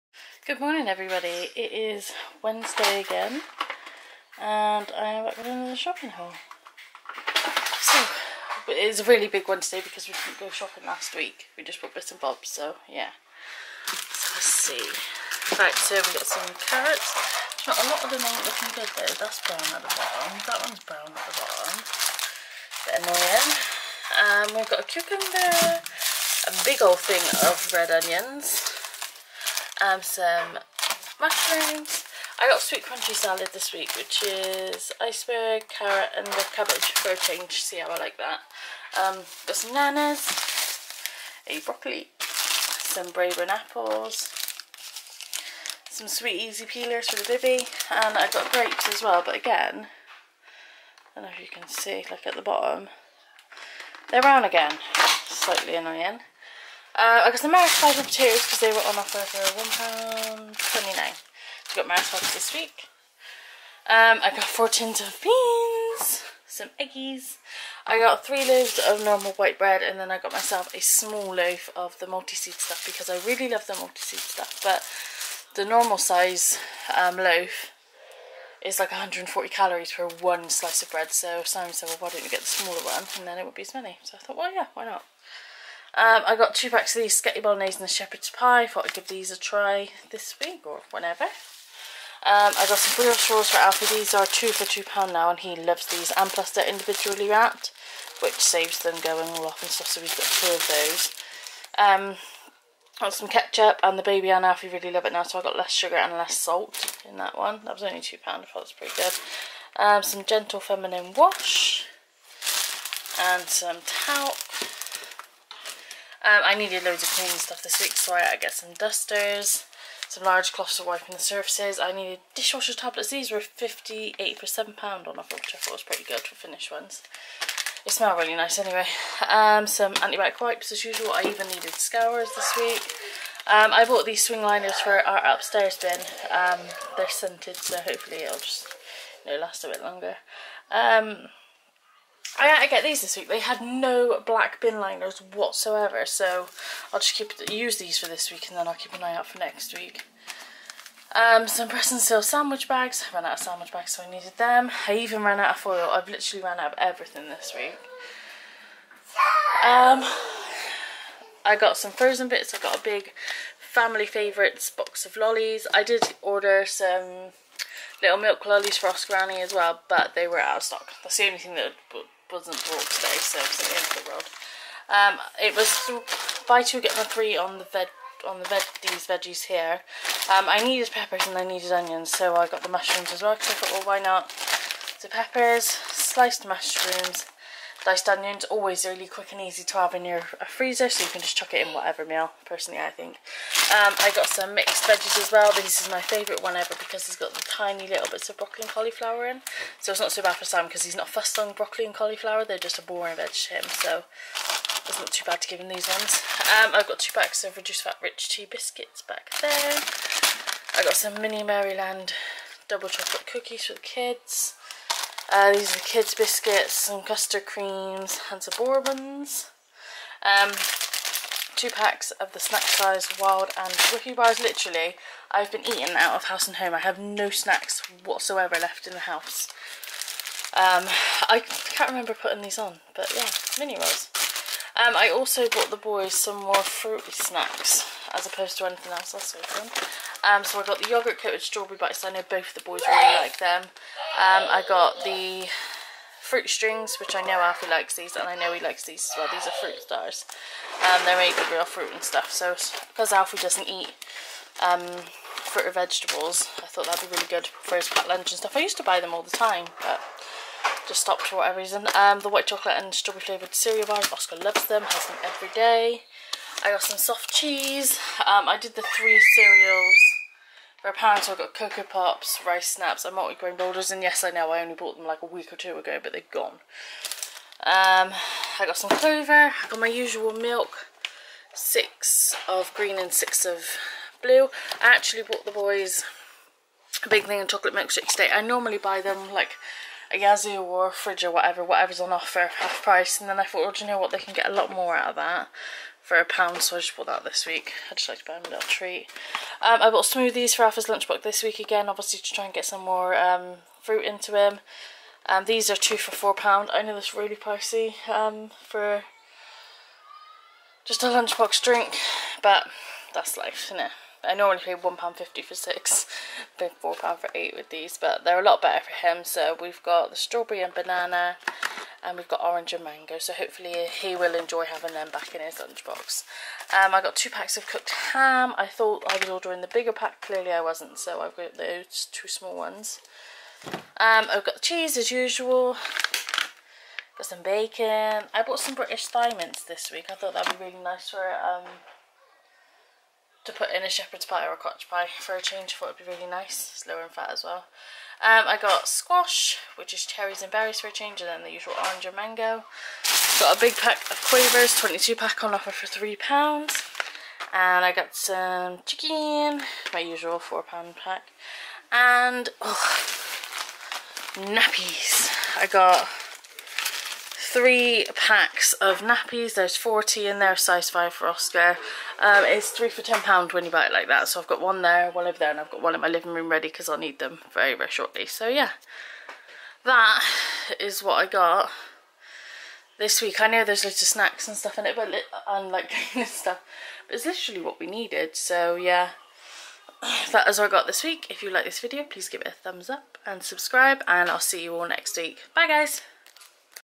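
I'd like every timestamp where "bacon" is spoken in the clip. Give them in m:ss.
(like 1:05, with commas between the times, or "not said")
5:37.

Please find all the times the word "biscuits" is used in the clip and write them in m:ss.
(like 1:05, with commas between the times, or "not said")
3:28, 3:36.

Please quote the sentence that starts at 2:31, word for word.
Um, some press and seal sandwich bags.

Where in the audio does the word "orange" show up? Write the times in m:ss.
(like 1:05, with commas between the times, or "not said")
5:22, 5:51.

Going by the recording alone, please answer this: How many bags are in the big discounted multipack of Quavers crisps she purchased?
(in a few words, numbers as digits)
22.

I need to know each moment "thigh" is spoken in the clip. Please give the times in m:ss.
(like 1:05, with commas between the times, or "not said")
5:39.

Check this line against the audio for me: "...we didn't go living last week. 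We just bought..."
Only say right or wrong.
wrong.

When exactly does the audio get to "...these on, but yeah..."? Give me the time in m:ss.
3:52.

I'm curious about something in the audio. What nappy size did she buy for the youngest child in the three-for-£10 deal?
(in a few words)
size 5.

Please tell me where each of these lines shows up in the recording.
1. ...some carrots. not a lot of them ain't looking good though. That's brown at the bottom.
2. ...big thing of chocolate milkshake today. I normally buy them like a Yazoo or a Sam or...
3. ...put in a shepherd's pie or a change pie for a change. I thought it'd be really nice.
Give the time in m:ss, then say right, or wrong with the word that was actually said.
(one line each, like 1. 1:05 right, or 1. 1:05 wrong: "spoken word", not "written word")
1. 0:16 right
2. 4:47 wrong: "Frijj", not "Sam"
3. 5:43 wrong: "cottage", not "change".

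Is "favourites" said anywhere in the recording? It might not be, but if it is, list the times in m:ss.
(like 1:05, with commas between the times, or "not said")
2:44, 3:15.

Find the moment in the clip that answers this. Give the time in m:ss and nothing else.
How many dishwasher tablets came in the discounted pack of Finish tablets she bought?
2:03.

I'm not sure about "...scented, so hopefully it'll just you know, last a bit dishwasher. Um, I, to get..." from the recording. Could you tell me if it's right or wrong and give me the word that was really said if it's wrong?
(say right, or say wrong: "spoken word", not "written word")
wrong: "longer", not "dishwasher".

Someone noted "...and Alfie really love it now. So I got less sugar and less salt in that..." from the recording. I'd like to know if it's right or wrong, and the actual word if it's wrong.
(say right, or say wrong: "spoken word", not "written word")
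right.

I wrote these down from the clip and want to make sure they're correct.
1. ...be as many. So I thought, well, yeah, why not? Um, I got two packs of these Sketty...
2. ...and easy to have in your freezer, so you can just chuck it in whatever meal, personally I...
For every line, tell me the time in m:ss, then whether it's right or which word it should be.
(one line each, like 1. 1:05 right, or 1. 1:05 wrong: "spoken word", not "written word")
1. 1:23 right
2. 3:09 right.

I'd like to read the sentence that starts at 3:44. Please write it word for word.
Literally, I've been eating out of house and home.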